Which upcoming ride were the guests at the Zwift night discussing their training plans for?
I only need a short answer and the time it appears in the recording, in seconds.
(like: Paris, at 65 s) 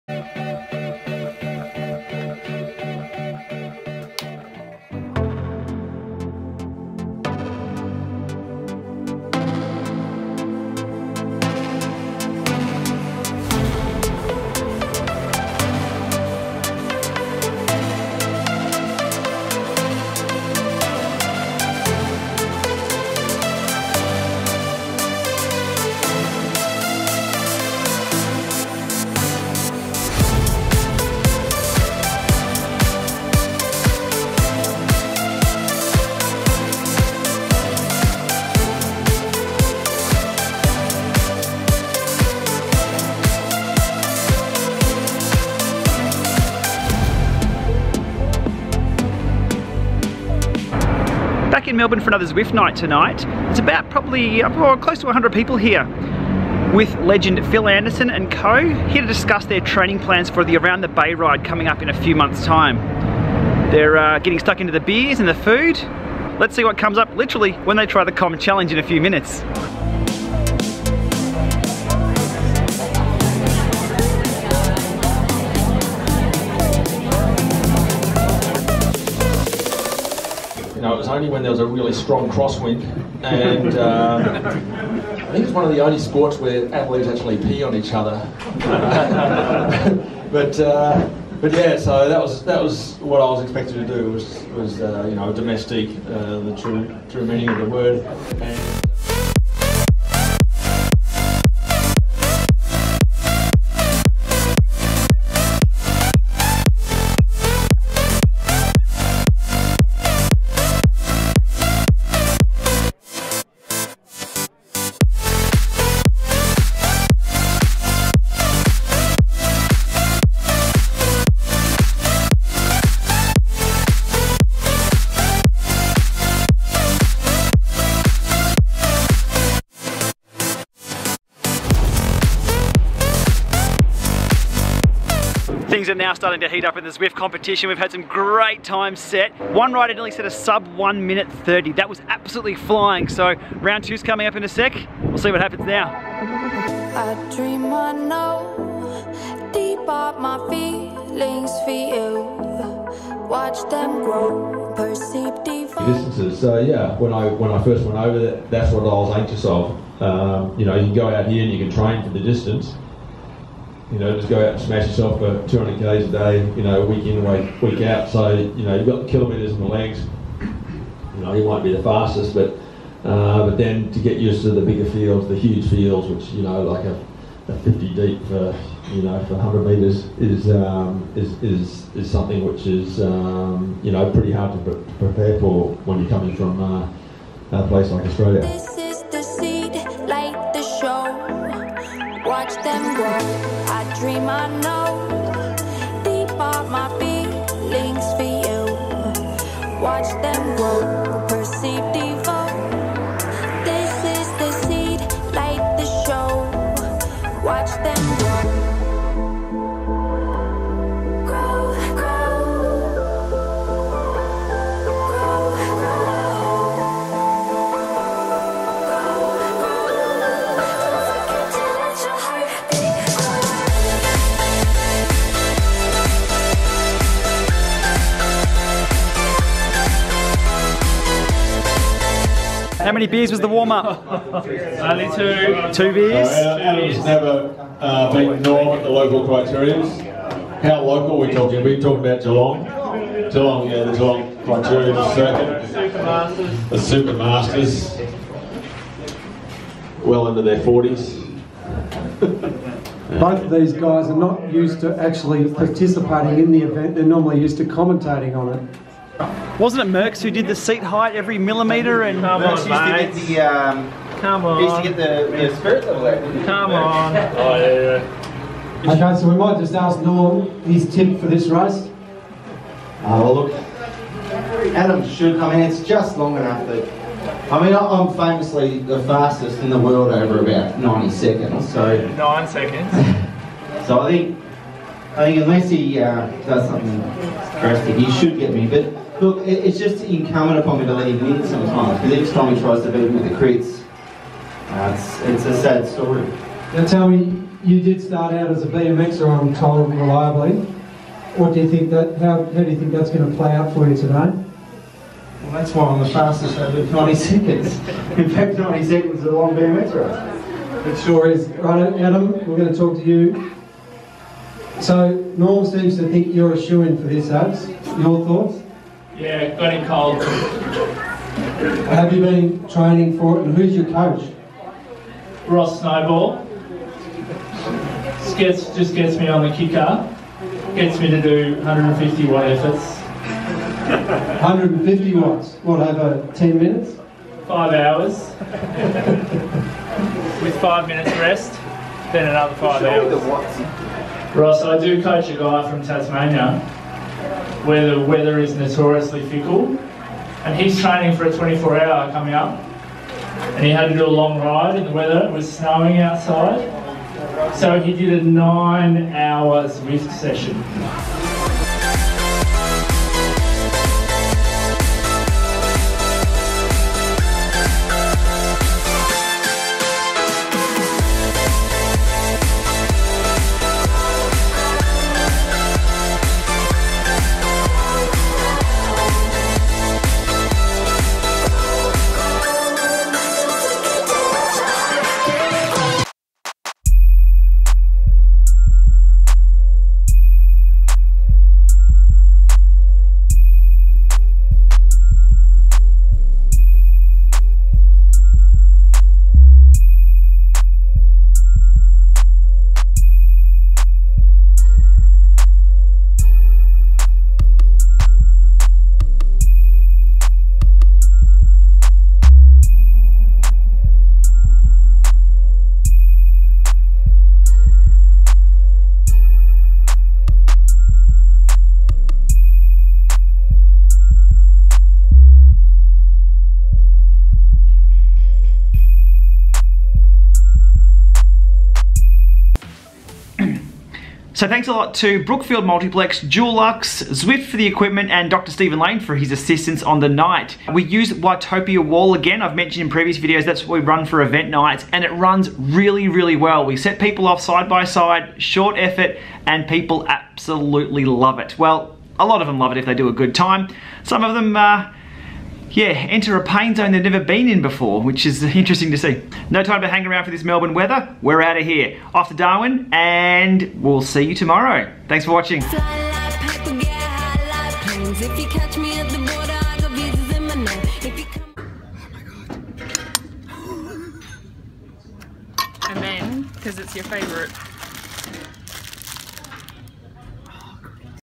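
Around the Bay, at 60 s.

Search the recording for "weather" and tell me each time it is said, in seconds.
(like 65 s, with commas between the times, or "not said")
347 s, 354 s, 460 s.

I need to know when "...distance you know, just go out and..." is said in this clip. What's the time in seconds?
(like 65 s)
162 s.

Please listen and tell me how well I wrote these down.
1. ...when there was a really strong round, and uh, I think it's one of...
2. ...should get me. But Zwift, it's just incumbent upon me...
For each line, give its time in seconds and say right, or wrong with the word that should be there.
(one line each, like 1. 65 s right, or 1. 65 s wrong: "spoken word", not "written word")
1. 81 s wrong: "crosswind", not "round"
2. 288 s wrong: "Look", not "Zwift".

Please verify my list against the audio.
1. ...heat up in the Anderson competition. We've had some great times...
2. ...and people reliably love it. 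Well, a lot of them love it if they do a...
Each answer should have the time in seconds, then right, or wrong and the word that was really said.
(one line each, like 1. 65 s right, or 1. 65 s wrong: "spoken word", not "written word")
1. 136 s wrong: "Zwift", not "Anderson"
2. 449 s wrong: "absolutely", not "reliably".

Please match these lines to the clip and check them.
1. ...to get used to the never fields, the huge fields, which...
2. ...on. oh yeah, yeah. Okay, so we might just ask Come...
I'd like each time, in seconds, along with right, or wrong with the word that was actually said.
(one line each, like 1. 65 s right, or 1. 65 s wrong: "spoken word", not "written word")
1. 173 s wrong: "bigger", not "never"
2. 266 s wrong: "Norm", not "Come".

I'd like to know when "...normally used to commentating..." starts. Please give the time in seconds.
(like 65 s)
257 s.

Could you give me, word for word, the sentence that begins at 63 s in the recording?
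They're uh, getting stuck into the beers and the food.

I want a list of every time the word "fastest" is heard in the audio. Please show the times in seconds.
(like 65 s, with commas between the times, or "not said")
171 s, 279 s, 306 s.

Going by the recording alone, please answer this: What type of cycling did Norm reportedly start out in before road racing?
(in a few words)
BMX.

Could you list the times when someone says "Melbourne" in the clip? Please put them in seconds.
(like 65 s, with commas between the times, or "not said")
51 s, 460 s.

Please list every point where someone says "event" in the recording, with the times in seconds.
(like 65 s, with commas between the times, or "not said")
256 s, 444 s.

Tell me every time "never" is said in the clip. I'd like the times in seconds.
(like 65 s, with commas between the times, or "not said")
237 s, 457 s.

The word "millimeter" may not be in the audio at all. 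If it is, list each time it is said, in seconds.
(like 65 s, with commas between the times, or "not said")
261 s.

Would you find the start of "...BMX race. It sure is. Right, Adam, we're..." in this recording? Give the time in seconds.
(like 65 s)
309 s.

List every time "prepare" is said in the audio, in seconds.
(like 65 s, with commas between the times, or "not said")
184 s.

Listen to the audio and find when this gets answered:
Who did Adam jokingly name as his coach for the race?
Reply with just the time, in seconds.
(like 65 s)
325 s.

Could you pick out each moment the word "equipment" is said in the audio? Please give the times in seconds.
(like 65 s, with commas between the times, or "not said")
437 s.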